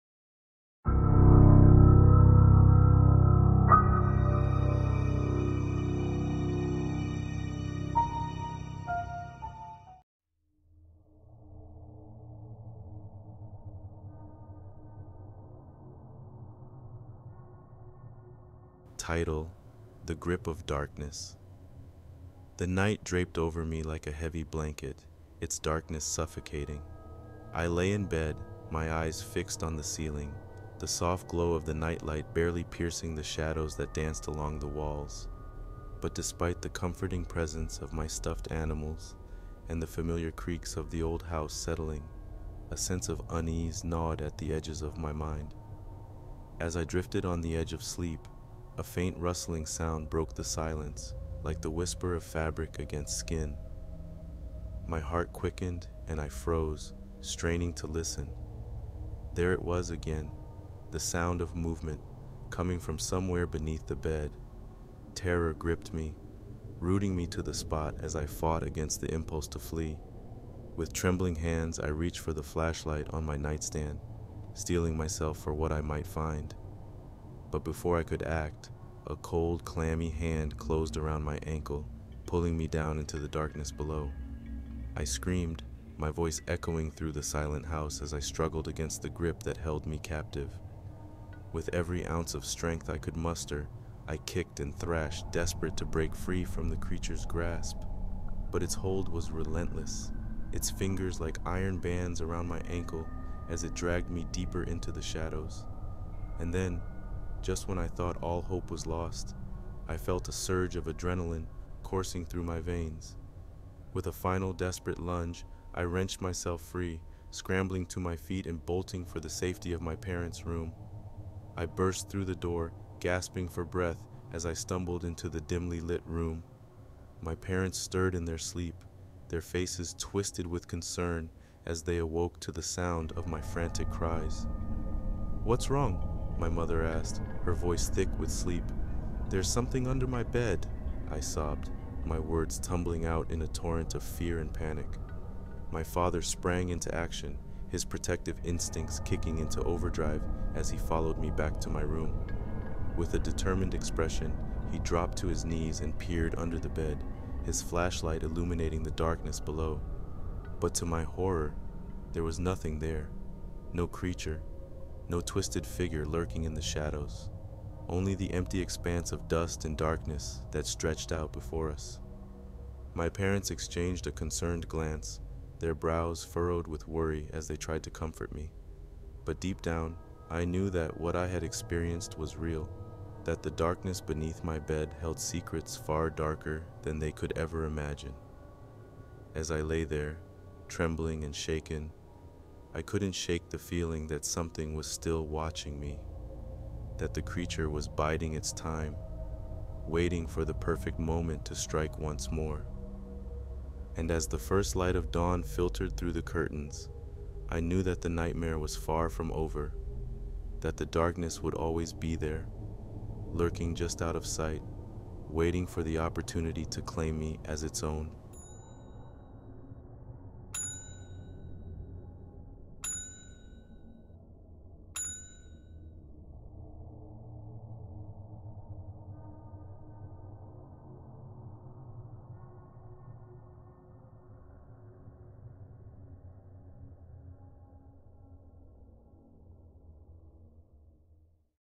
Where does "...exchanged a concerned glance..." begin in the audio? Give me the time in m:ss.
2:53.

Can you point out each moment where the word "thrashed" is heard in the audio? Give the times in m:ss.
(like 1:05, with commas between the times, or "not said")
1:34.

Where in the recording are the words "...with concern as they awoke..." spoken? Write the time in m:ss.
2:10.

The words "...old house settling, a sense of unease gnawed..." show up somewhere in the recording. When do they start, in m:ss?
0:41.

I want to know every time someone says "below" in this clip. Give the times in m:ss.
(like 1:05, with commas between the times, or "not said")
1:23, 2:39.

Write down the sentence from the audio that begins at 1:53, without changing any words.
With a final desperate lunge, I wrenched myself free, scrambling to my feet and bolting for the safety of my parents' room.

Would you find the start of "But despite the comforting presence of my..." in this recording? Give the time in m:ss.
0:35.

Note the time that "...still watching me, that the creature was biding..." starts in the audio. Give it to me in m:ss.
3:14.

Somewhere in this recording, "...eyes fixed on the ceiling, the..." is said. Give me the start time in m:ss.
0:28.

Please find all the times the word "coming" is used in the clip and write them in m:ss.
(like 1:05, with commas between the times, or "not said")
1:02.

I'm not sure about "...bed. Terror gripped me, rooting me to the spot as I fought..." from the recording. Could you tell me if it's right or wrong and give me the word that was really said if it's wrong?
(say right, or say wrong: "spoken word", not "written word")
right.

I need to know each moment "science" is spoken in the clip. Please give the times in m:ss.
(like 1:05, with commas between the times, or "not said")
not said.